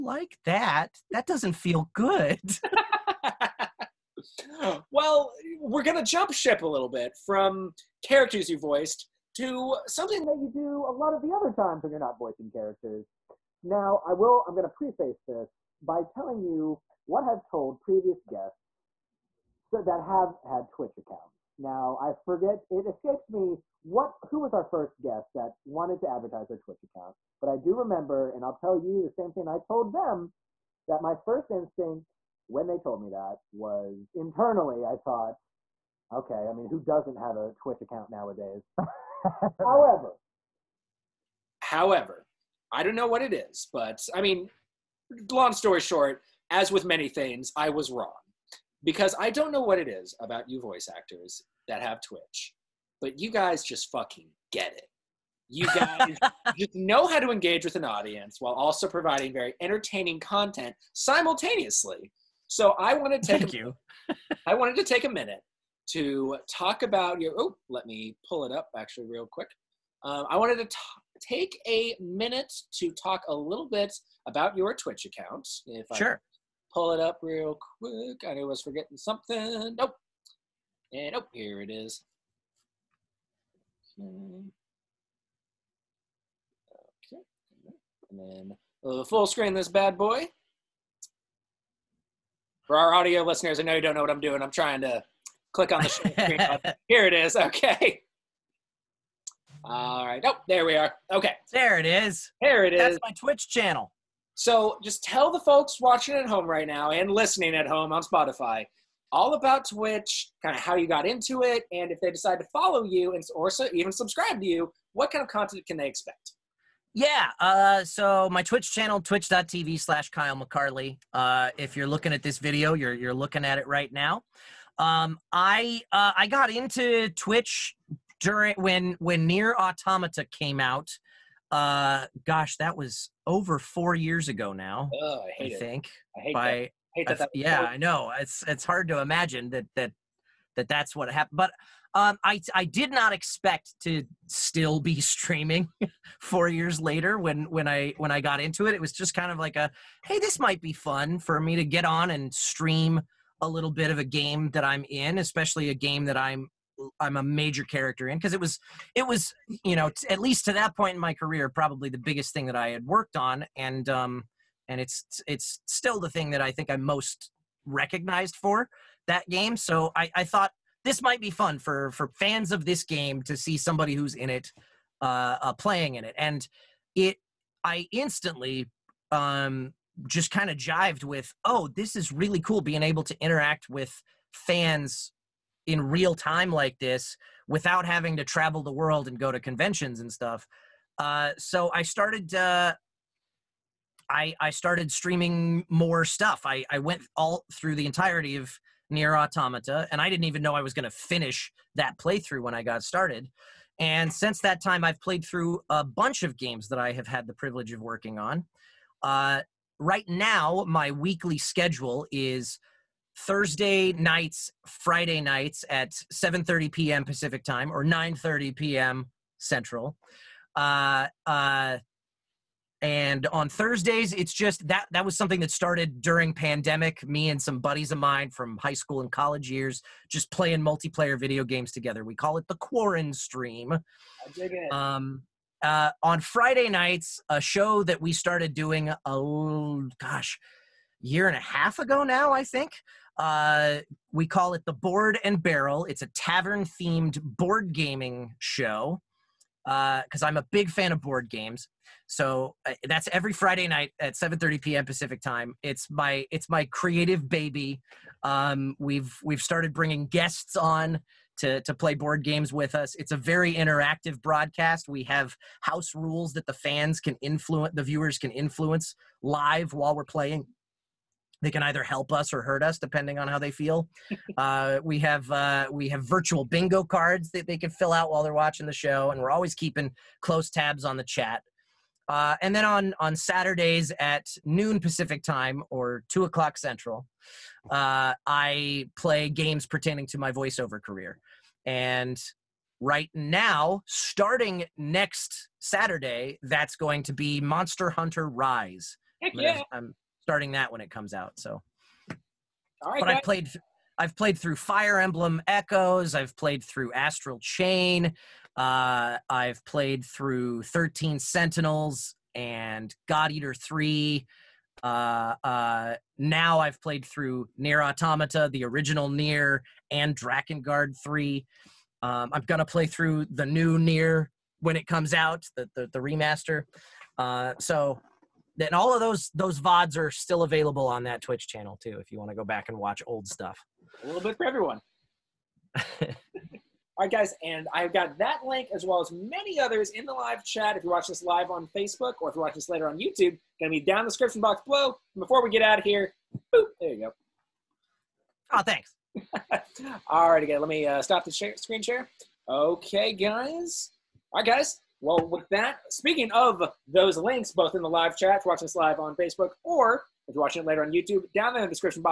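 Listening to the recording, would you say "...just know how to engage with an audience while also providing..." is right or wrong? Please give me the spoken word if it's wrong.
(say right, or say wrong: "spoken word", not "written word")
right.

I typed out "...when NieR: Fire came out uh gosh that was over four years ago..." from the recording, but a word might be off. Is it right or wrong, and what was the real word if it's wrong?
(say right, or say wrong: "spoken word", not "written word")
wrong: "Automata", not "Fire".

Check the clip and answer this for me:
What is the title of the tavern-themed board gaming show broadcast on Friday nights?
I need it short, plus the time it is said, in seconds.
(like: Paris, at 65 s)
Board and Barrel, at 244 s.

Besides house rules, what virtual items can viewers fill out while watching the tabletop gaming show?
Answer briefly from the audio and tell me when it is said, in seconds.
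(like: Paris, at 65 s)
bingo cards, at 276 s.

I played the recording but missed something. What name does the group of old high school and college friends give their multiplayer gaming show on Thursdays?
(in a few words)
Quarren Stream.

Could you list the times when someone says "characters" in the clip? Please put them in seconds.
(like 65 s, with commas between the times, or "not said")
8 s, 12 s, 157 s.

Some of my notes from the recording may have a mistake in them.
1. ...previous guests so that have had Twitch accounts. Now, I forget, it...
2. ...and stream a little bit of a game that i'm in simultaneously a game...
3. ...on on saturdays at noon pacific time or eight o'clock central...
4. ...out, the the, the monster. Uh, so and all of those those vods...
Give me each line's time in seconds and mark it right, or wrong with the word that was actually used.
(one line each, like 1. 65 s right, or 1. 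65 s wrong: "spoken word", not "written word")
1. 17 s right
2. 152 s wrong: "especially", not "simultaneously"
3. 282 s wrong: "two", not "eight"
4. 325 s wrong: "remaster", not "monster".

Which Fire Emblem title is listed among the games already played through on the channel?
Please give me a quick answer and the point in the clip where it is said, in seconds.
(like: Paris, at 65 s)
Fire Emblem Echoes, at 304 s.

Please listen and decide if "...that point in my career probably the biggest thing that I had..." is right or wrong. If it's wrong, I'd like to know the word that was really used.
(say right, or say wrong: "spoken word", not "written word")
right.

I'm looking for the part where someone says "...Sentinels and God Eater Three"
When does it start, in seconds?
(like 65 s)
311 s.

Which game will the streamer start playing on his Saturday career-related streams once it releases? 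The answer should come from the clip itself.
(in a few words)
Monster Hunter Rise.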